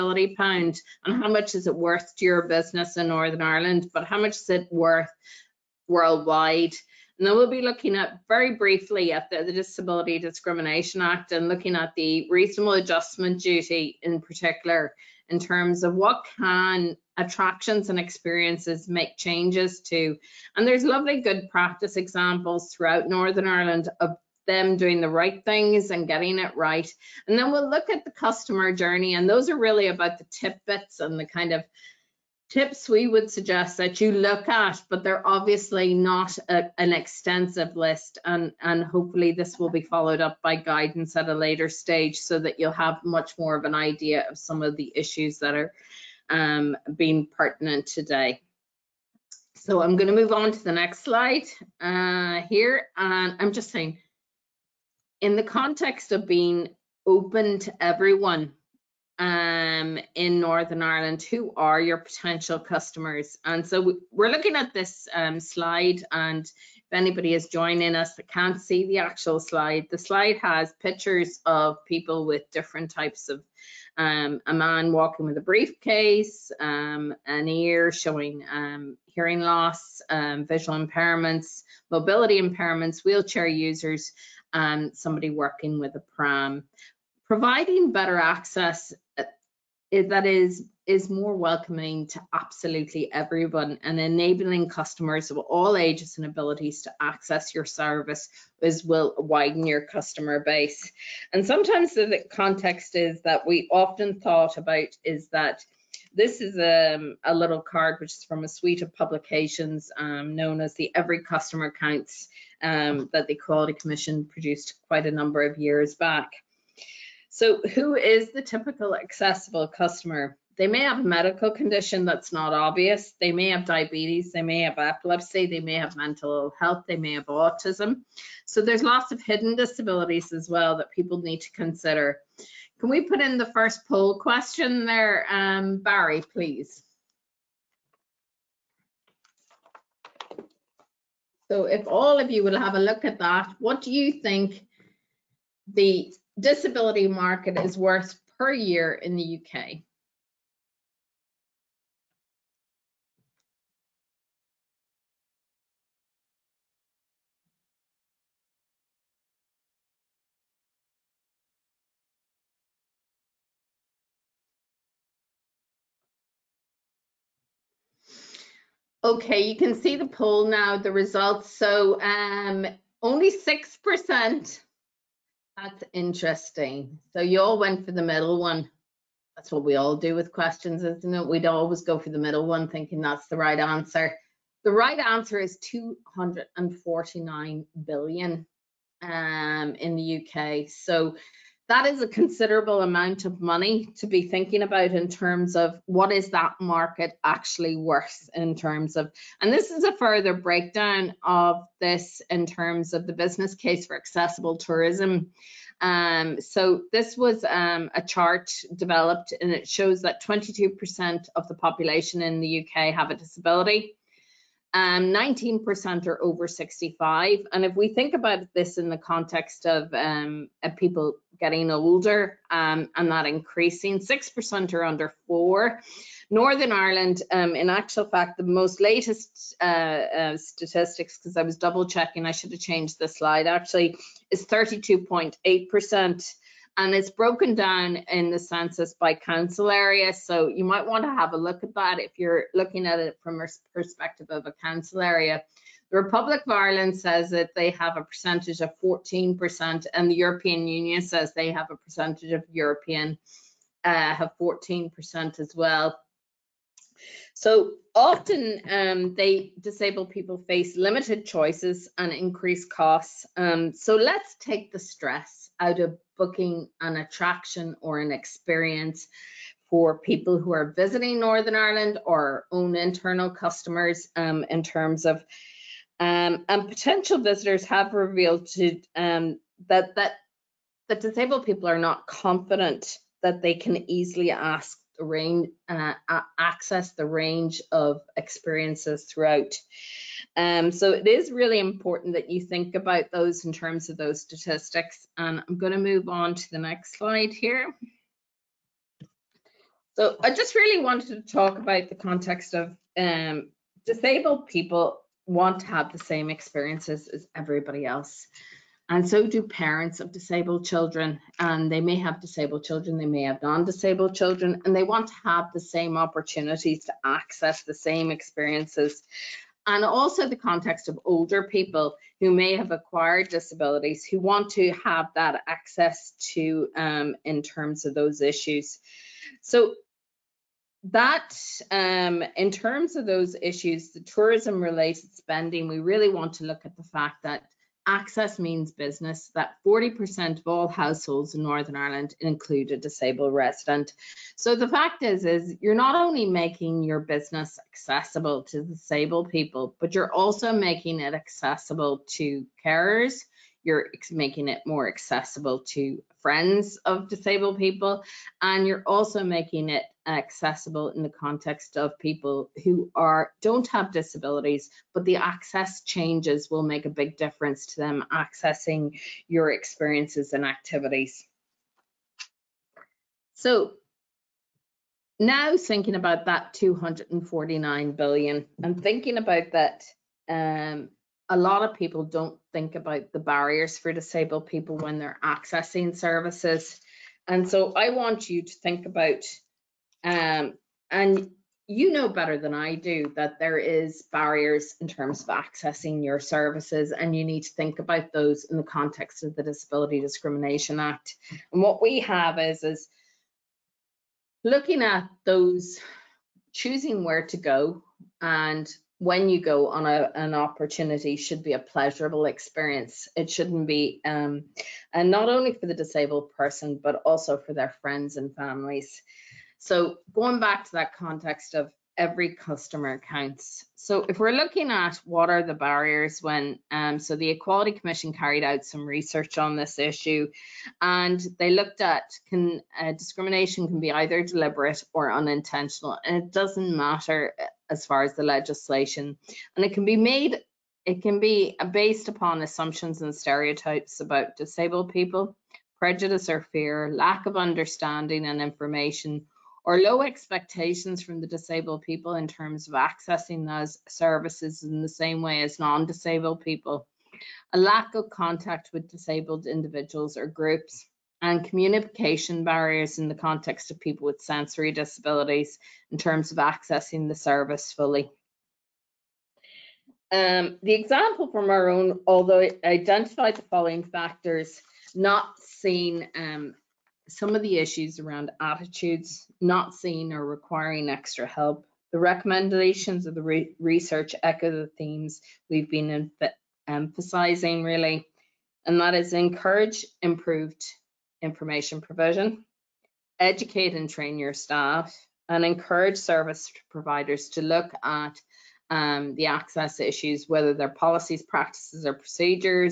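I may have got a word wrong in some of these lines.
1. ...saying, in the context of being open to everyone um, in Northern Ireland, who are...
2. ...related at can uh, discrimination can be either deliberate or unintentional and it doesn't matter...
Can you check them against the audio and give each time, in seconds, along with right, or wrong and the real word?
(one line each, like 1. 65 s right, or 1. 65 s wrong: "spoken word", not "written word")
1. 53 s right
2. 431 s wrong: "looked", not "related".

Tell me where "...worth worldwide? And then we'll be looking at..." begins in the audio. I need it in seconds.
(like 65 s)
4 s.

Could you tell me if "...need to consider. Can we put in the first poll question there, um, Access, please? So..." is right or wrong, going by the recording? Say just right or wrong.
wrong.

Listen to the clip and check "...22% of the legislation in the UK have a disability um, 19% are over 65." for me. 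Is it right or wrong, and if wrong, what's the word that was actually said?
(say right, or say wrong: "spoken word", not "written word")
wrong: "population", not "legislation".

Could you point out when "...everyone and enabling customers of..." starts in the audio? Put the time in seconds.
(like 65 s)
93 s.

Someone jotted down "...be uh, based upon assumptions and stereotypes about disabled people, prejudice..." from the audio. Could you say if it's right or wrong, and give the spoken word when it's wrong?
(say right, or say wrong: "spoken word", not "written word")
right.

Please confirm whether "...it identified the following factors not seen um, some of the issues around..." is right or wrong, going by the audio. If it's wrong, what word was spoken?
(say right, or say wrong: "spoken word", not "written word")
right.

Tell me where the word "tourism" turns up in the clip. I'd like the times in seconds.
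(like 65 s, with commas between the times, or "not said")
204 s, 333 s.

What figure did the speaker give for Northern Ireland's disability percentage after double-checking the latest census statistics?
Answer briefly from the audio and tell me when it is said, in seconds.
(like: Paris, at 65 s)
32.8%, at 234 s.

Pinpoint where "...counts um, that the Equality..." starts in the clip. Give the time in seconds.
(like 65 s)
111 s.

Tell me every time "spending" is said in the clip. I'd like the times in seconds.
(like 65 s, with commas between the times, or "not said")
335 s.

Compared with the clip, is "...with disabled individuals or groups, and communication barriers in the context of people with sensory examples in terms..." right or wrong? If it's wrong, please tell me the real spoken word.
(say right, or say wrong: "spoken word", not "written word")
wrong: "disabilities", not "examples".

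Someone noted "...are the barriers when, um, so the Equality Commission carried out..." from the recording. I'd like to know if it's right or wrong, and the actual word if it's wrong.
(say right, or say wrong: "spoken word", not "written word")
right.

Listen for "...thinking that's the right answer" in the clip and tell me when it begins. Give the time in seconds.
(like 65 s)
182 s.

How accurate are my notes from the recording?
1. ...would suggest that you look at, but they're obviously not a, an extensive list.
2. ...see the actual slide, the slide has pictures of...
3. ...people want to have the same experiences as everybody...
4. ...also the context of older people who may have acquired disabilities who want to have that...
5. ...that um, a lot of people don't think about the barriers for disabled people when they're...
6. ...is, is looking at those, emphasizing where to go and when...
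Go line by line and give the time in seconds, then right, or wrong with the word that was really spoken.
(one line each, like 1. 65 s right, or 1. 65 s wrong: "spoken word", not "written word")
1. 33 s right
2. 68 s right
3. 304 s right
4. 319 s right
5. 379 s right
6. 402 s wrong: "choosing", not "emphasizing".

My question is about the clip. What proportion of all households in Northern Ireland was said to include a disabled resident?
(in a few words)
40%.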